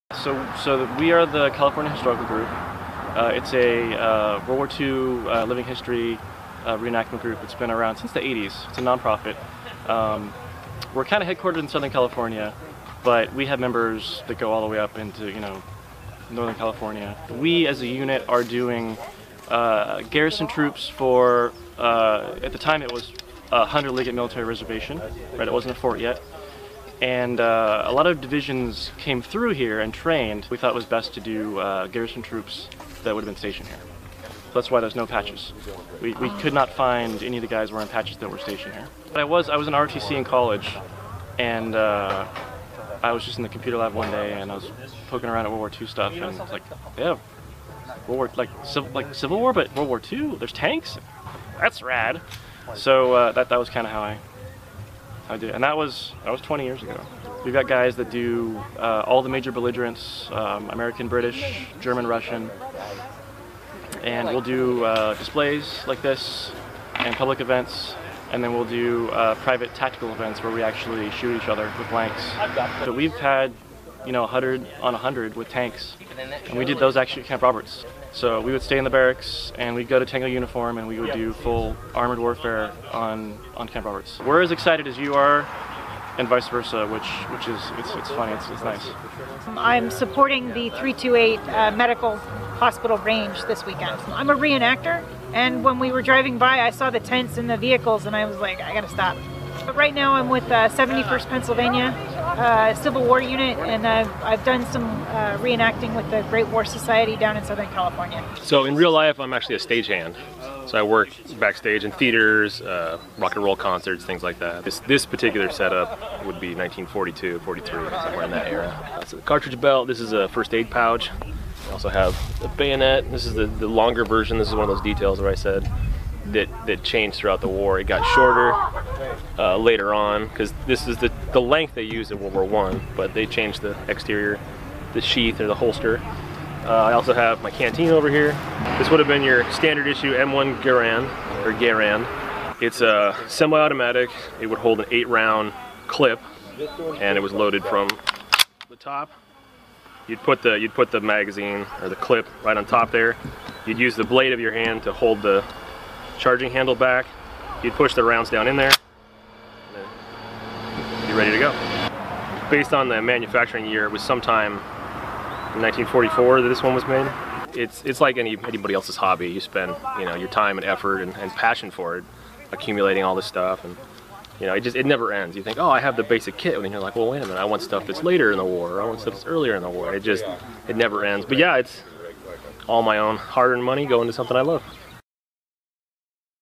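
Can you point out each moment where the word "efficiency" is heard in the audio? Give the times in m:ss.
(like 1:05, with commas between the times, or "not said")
not said.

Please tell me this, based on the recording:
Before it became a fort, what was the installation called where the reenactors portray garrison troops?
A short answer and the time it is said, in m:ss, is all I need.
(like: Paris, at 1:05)
Hunter Liggett Military Reservation, at 0:23.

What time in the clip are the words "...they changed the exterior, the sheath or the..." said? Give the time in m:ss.
2:13.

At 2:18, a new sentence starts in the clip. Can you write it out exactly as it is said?
This would have been your standard issue M1 Garand or Garand.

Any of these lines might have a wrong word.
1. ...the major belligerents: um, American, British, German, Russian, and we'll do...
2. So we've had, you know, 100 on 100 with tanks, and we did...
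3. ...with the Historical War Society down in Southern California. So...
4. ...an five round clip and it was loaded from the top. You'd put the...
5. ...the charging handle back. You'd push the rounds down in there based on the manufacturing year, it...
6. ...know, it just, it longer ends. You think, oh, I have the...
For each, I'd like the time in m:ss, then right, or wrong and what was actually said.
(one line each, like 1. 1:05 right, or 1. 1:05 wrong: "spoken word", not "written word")
1. 0:59 right
2. 1:12 right
3. 1:45 wrong: "Great", not "Historical"
4. 2:24 wrong: "eight", not "five"
5. 2:35 right
6. 2:54 wrong: "never", not "longer".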